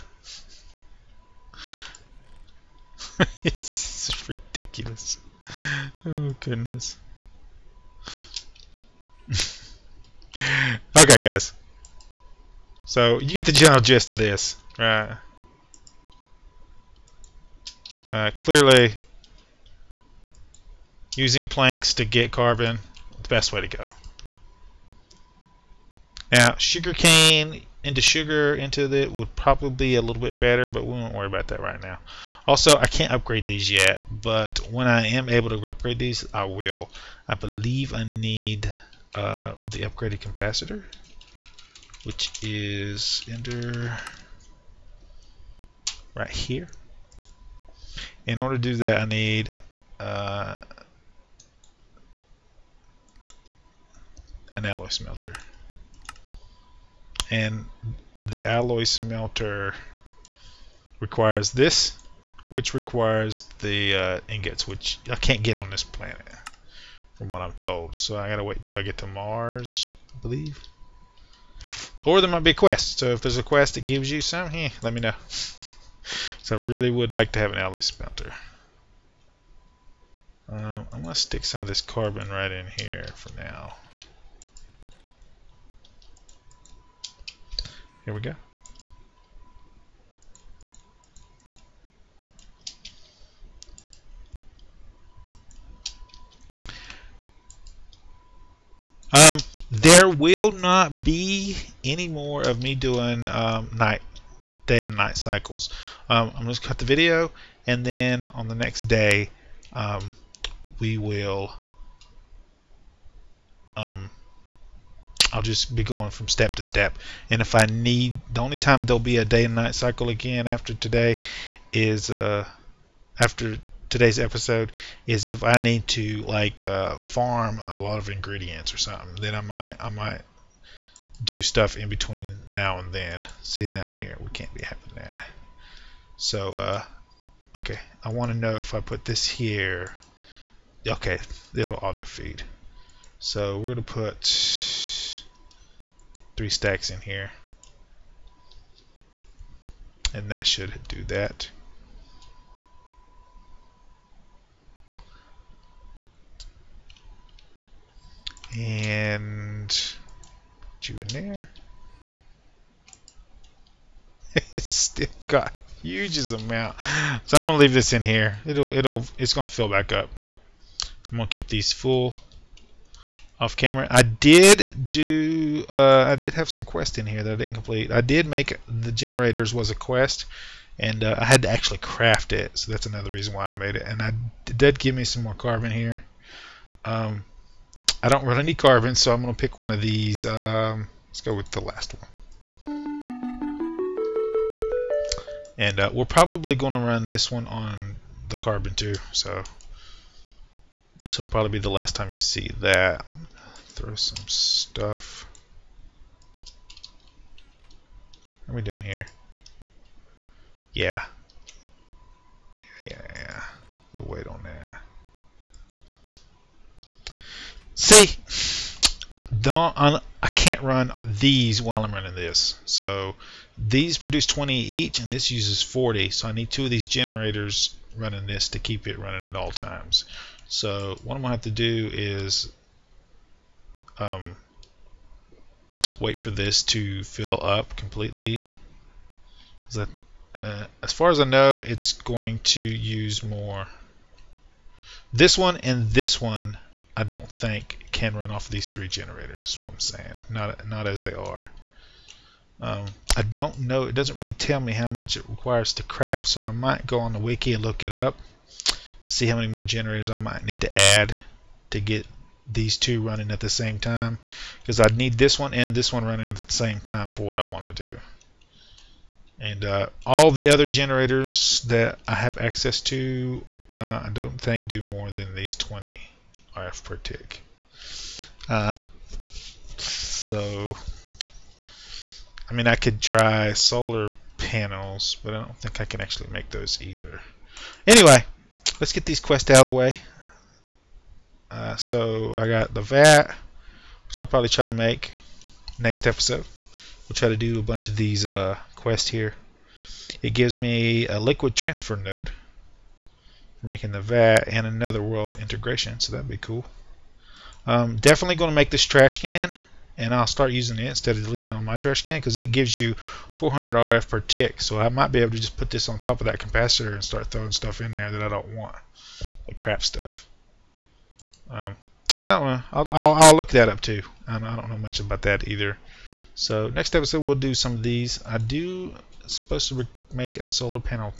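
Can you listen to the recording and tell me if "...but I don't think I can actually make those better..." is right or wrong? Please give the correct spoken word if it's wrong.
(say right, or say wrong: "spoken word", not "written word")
wrong: "either", not "better".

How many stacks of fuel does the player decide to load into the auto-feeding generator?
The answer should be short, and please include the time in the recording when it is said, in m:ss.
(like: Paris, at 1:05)
3, at 2:26.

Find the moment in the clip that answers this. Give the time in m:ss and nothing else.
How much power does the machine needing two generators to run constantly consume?
3:45.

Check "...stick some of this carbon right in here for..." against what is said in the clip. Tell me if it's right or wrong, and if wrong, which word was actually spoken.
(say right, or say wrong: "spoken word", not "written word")
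right.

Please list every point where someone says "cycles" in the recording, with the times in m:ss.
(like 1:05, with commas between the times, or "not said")
1:45, 1:59.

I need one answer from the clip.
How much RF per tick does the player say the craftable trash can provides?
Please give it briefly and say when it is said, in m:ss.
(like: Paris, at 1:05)
400 RF per tick, at 5:13.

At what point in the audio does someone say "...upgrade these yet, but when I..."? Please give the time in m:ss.
0:33.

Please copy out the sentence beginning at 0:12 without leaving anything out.
So you get the general gist of this, right?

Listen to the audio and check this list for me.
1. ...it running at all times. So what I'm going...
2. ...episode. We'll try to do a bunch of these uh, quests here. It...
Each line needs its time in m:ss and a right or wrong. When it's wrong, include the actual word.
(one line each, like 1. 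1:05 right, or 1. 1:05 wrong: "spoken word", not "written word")
1. 3:48 right
2. 4:56 right.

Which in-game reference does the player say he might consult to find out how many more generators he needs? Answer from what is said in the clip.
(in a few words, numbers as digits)
the wiki.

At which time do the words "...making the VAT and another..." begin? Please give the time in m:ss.
5:03.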